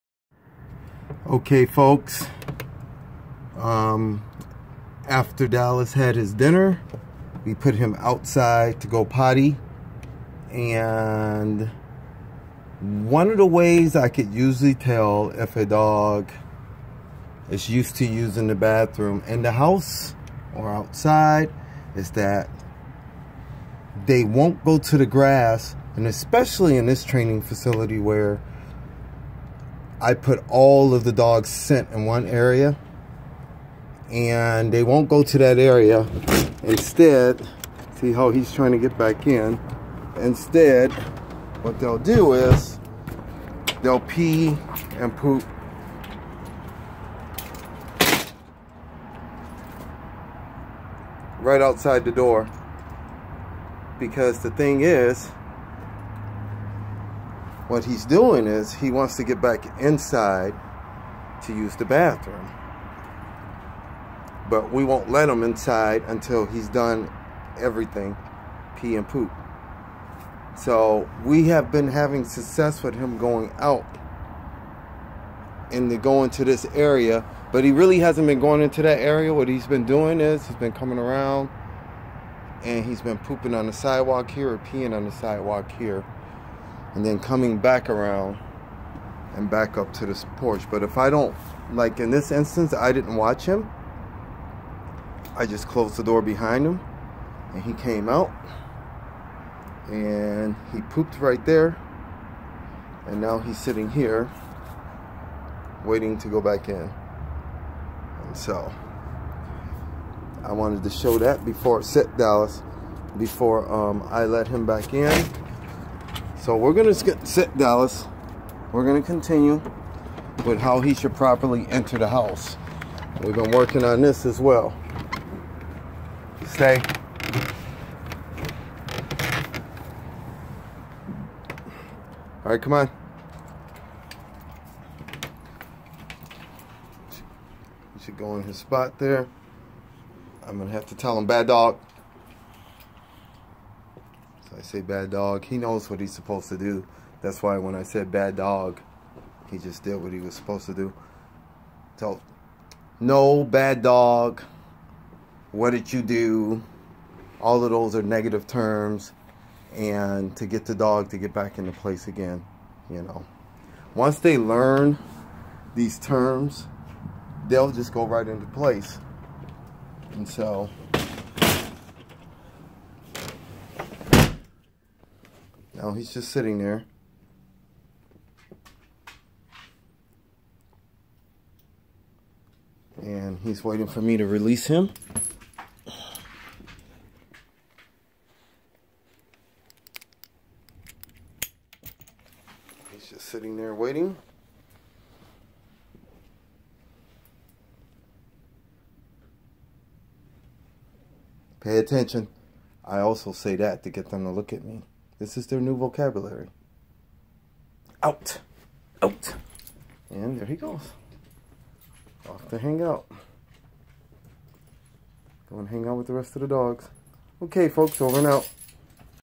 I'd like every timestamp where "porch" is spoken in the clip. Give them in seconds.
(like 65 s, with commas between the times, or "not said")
90 s.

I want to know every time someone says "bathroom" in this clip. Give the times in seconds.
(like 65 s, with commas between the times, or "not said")
18 s, 61 s.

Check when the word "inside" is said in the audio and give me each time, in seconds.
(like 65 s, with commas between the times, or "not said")
59 s, 65 s.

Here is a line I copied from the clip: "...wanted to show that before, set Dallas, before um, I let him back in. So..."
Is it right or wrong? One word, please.
right.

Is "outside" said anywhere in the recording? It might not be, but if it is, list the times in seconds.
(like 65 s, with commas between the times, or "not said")
7 s, 20 s, 51 s.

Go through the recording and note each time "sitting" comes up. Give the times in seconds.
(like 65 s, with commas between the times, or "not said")
103 s, 176 s, 193 s.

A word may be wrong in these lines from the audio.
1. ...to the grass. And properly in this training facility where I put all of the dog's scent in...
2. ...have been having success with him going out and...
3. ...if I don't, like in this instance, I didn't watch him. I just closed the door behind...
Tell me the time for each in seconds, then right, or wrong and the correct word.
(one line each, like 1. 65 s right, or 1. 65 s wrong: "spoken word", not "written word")
1. 24 s wrong: "especially", not "properly"
2. 71 s right
3. 90 s right.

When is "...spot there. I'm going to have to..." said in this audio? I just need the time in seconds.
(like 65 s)
138 s.